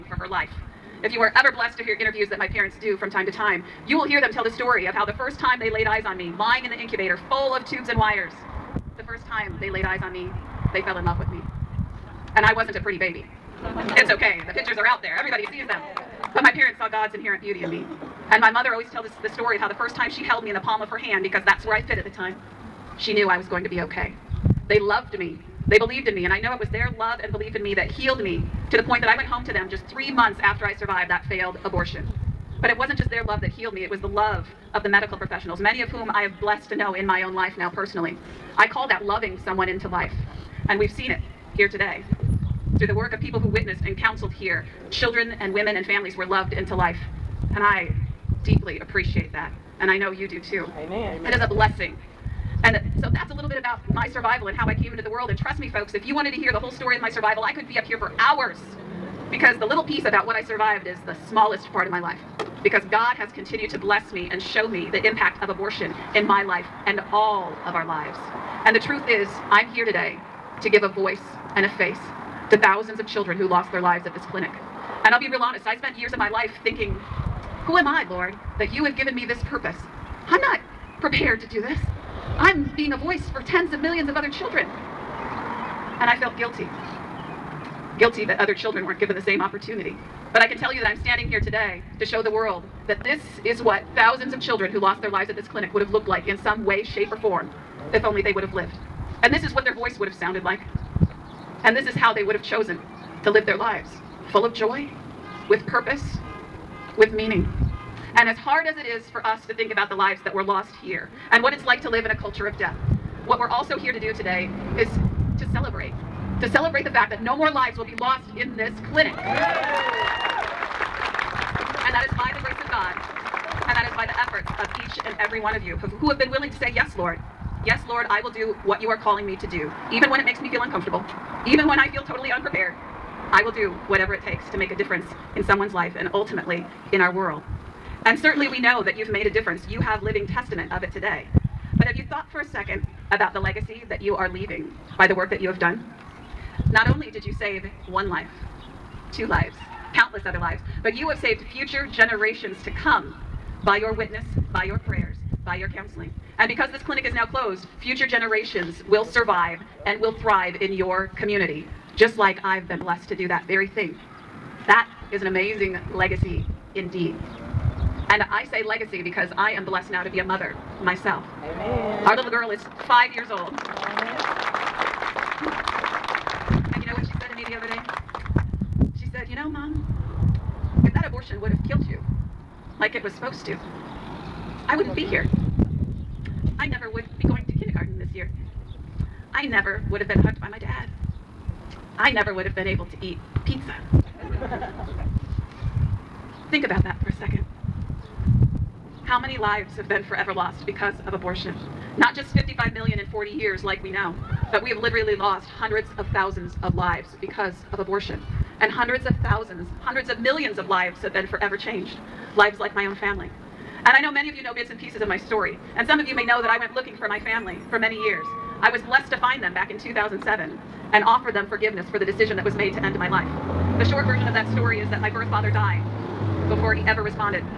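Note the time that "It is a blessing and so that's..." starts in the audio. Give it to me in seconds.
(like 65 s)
51 s.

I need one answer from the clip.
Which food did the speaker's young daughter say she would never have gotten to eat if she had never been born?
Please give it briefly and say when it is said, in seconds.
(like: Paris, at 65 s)
pizza, at 193 s.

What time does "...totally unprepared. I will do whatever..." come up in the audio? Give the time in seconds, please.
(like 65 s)
132 s.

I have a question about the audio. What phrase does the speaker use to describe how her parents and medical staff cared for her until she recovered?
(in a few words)
loving someone into life.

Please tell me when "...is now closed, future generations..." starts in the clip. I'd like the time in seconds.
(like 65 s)
157 s.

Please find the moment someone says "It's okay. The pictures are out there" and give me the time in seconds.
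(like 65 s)
13 s.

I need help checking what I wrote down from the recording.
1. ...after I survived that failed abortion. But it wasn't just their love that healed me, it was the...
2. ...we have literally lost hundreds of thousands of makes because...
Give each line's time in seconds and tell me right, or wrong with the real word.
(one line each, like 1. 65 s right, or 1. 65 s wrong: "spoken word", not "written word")
1. 30 s right
2. 204 s wrong: "lives", not "makes".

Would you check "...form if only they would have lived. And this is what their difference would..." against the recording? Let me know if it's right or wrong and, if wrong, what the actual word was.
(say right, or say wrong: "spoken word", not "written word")
wrong: "voice", not "difference".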